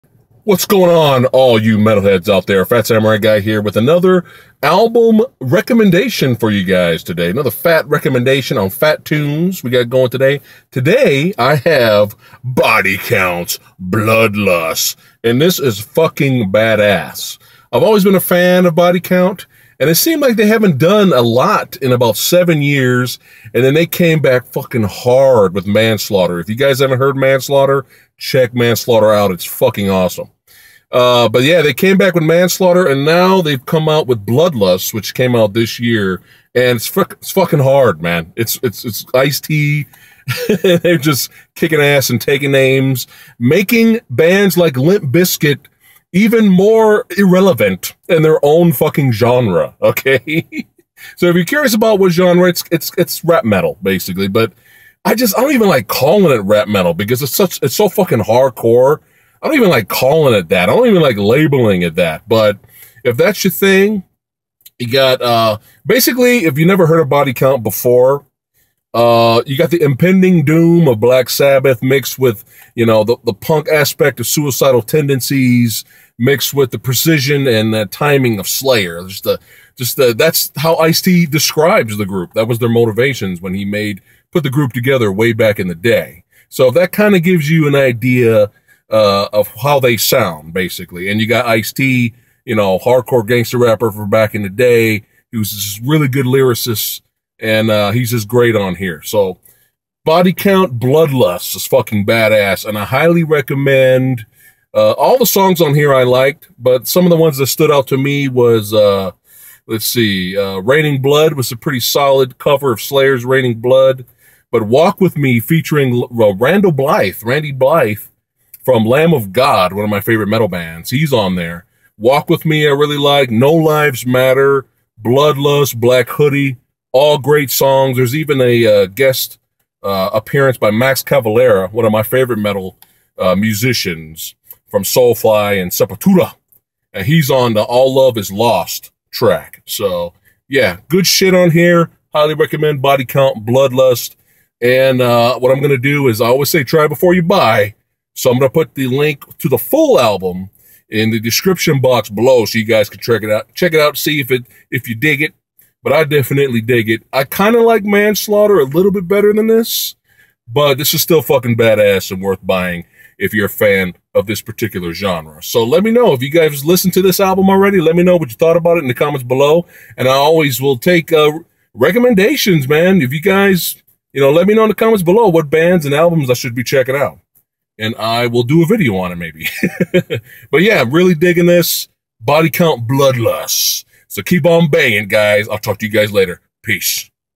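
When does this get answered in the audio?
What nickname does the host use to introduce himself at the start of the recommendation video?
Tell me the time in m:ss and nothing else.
0:02.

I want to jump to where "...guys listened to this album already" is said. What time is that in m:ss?
2:46.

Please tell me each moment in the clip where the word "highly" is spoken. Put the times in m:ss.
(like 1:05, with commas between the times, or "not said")
1:42, 2:22.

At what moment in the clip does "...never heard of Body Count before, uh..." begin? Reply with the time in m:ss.
1:06.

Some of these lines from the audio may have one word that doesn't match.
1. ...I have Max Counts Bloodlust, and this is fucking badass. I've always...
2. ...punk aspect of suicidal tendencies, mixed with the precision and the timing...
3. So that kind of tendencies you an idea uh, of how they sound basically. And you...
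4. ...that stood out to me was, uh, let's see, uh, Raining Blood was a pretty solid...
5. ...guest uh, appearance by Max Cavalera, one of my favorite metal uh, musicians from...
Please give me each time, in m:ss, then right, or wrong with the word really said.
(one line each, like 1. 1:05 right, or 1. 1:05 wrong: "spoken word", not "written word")
1. 0:11 wrong: "Body", not "Max"
2. 1:13 right
3. 1:26 wrong: "gives", not "tendencies"
4. 1:47 right
5. 2:08 right.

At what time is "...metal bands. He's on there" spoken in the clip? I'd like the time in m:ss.
2:00.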